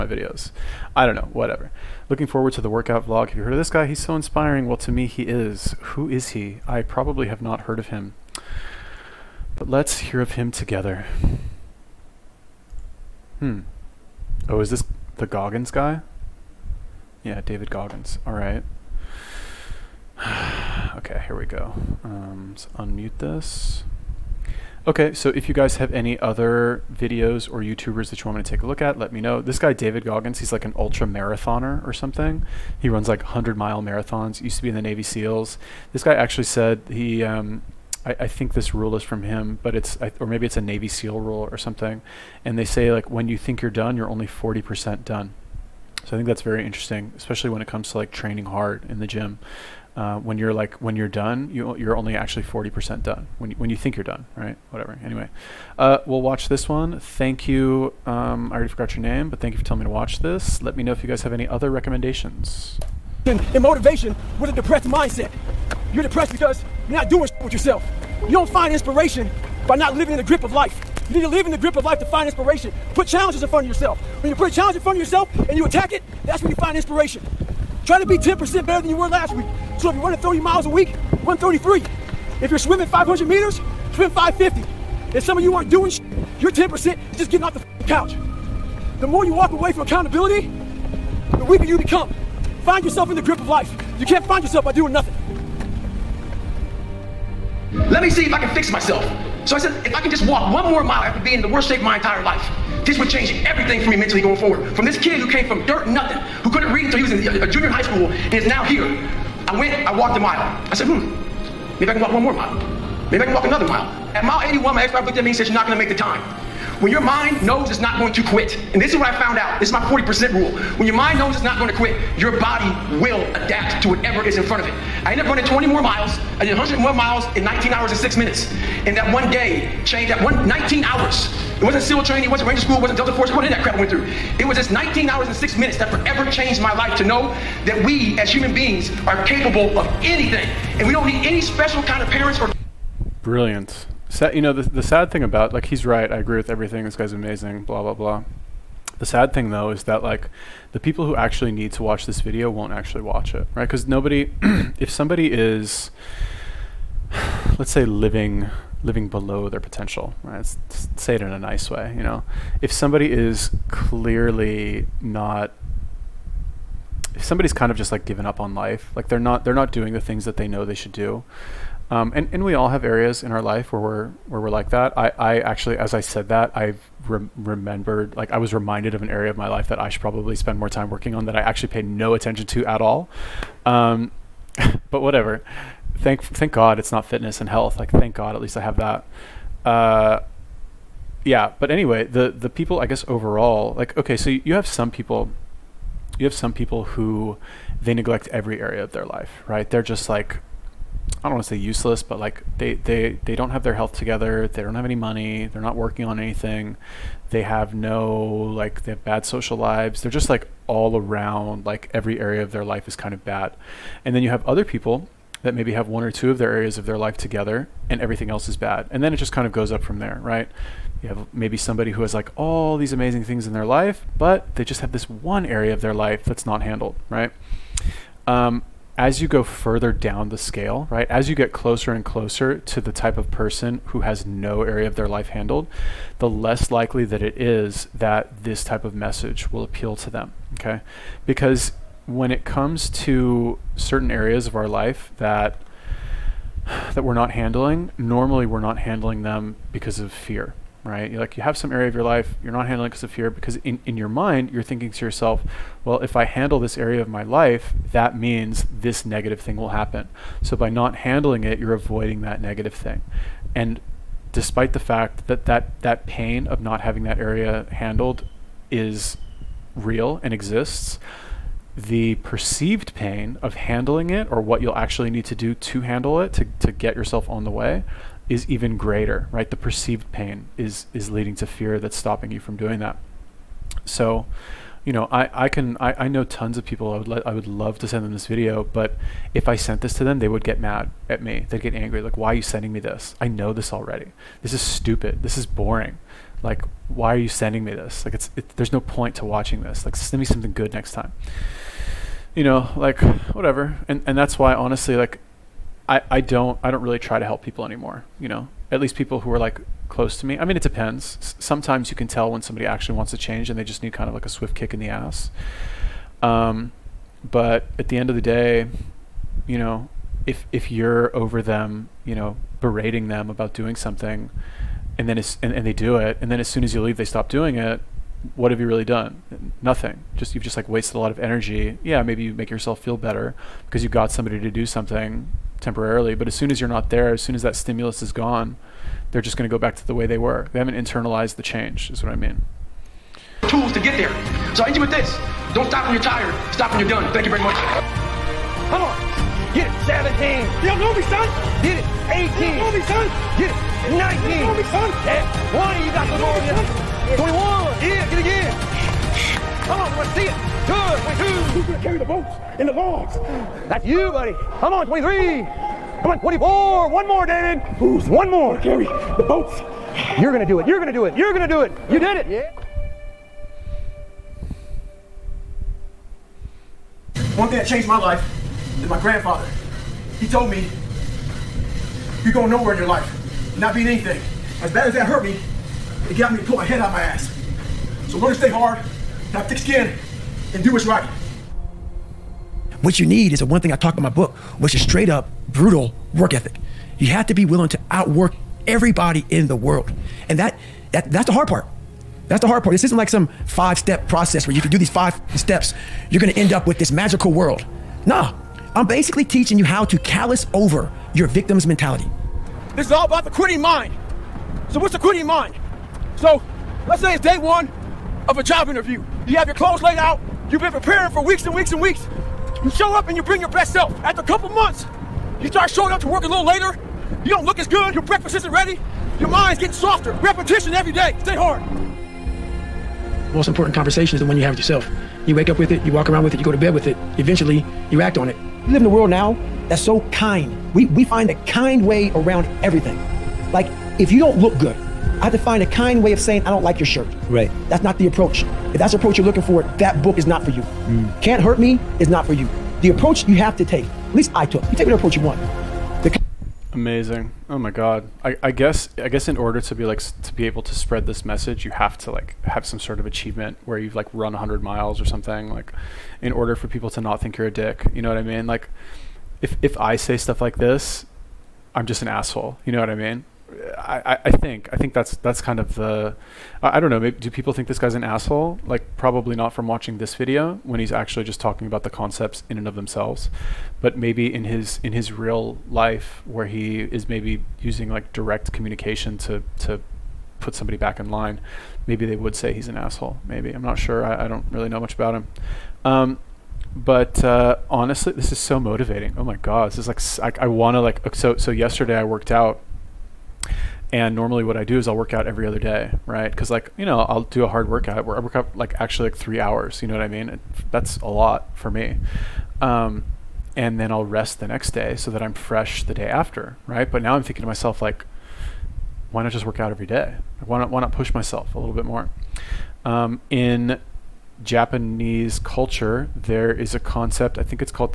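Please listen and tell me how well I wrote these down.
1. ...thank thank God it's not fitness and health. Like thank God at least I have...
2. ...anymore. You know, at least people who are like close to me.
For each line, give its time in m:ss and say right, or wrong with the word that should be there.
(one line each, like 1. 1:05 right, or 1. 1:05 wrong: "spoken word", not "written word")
1. 3:05 right
2. 5:07 right.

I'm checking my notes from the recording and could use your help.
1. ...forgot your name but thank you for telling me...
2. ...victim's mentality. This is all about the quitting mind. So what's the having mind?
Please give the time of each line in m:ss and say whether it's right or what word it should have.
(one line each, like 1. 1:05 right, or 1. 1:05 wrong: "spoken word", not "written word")
1. 0:58 right
2. 6:51 wrong: "quitting", not "having".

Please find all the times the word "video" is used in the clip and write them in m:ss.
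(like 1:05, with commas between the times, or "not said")
0:00, 0:26, 2:32, 4:48, 8:00.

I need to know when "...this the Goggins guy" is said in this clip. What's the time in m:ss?
0:14.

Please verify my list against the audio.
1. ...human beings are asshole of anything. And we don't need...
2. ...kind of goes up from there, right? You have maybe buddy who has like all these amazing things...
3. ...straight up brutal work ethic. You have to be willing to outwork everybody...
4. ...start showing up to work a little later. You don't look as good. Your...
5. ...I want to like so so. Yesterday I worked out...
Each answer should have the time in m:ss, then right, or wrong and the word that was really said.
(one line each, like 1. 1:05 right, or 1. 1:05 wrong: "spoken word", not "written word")
1. 2:18 wrong: "capable", not "asshole"
2. 3:39 wrong: "somebody", not "buddy"
3. 6:34 right
4. 7:05 right
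5. 8:20 right.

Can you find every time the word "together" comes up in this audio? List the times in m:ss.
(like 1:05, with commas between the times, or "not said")
0:10, 3:23, 3:37.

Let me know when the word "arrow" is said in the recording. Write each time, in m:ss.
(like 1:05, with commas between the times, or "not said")
not said.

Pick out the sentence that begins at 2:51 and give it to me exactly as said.
Um, and, and we all have areas in our life where we're where we're like that.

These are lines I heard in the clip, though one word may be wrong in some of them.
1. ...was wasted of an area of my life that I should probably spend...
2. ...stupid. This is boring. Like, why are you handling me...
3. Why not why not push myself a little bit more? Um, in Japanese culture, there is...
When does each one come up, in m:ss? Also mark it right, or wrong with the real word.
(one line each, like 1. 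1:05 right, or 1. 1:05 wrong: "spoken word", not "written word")
1. 2:58 wrong: "reminded", not "wasted"
2. 4:54 wrong: "sending", not "handling"
3. 8:40 right.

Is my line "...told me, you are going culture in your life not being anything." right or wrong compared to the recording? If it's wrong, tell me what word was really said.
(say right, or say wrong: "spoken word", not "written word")
wrong: "nowhere", not "culture".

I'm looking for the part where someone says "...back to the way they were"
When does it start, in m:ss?
5:39.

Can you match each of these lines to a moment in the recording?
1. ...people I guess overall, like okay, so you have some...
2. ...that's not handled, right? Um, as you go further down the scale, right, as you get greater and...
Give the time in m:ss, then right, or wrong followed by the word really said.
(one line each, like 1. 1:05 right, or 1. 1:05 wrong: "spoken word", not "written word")
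1. 3:12 right
2. 3:46 wrong: "closer", not "greater".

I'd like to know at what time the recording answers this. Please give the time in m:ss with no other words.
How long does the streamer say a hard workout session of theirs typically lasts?
8:29.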